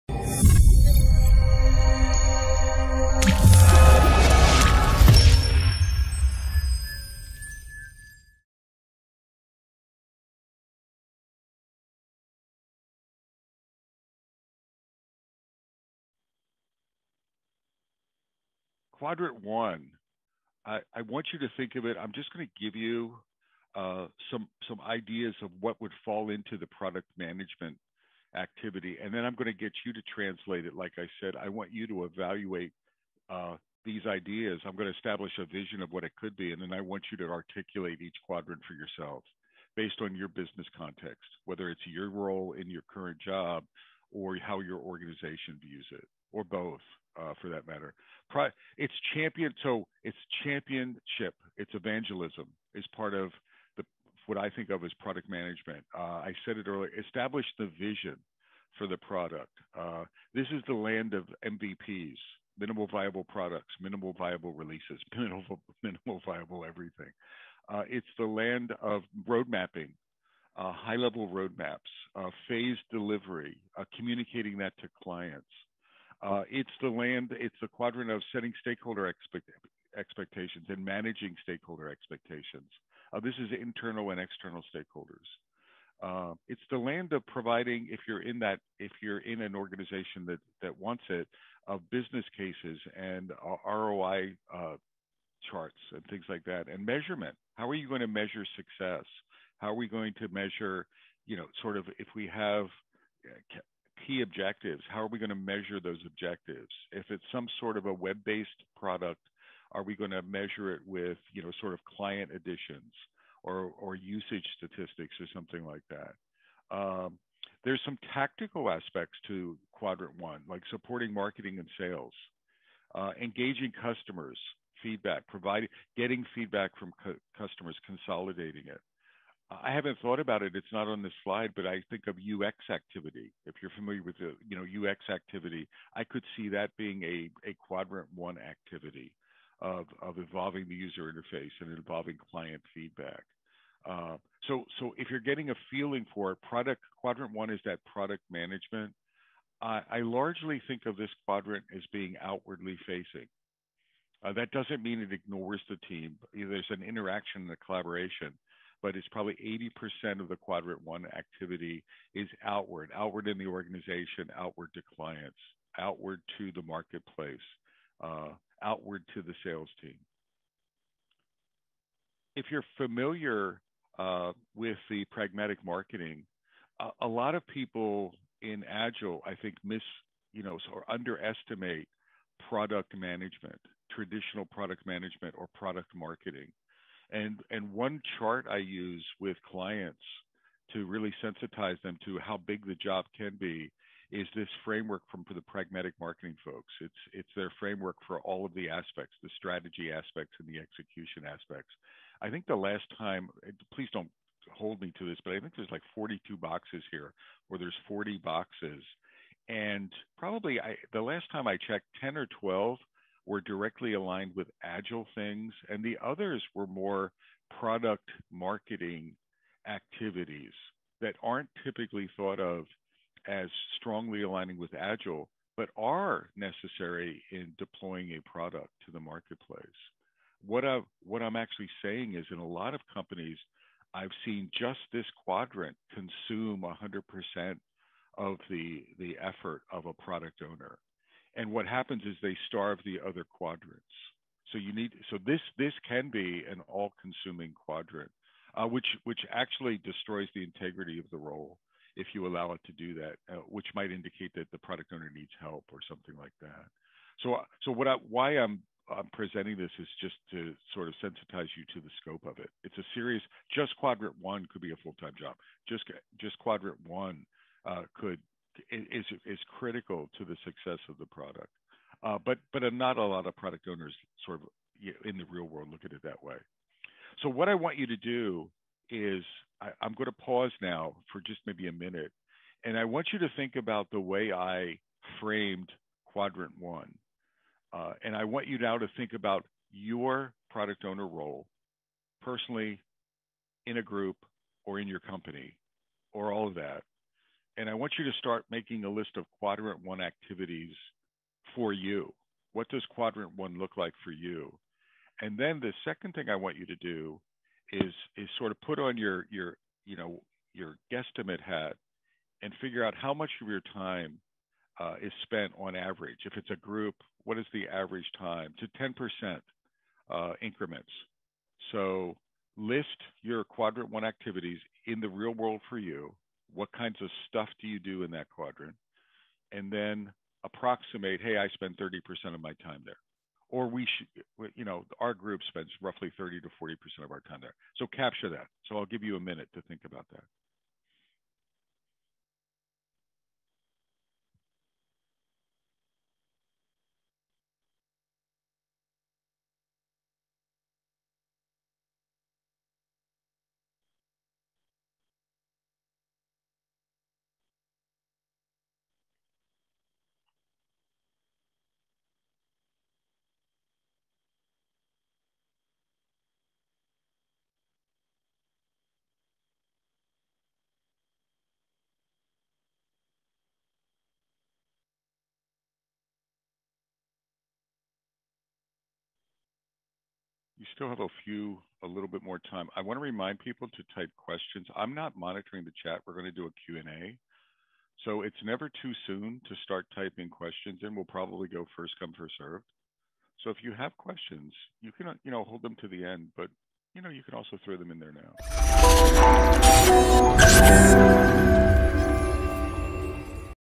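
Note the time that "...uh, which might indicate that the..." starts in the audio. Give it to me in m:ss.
4:13.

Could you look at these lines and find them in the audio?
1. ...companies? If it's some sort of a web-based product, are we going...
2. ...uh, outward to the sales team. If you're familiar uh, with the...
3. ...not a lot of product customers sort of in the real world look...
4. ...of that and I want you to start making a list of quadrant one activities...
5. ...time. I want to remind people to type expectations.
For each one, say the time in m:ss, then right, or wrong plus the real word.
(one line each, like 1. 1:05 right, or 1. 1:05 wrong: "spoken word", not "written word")
1. 1:46 wrong: "objectives", not "companies"
2. 2:48 right
3. 4:32 wrong: "owners", not "customers"
4. 4:56 right
5. 6:22 wrong: "questions", not "expectations".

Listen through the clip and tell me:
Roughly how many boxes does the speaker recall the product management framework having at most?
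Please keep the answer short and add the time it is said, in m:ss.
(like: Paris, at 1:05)
42, at 3:25.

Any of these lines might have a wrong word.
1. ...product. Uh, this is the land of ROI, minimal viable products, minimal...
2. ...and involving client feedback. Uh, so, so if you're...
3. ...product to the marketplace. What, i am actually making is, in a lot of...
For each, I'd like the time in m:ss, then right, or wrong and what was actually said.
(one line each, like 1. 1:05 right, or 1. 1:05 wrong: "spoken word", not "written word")
1. 0:58 wrong: "MVPs", not "ROI"
2. 2:21 right
3. 3:48 wrong: "saying", not "making".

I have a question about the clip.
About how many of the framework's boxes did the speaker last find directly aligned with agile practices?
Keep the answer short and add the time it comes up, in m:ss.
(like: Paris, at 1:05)
10 or 12, at 3:32.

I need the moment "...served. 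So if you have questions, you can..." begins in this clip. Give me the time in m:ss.
6:32.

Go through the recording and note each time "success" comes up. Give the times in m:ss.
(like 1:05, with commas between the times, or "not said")
1:38, 4:30.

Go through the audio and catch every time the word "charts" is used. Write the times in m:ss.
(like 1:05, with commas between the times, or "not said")
1:35, 3:08.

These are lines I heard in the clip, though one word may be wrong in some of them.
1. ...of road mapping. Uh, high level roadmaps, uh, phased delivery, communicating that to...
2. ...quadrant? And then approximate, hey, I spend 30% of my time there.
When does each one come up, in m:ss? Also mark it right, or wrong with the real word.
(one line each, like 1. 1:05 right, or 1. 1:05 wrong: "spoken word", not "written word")
1. 1:08 right
2. 5:28 right.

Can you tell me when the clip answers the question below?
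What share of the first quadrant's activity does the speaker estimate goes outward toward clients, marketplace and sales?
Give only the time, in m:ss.
2:40.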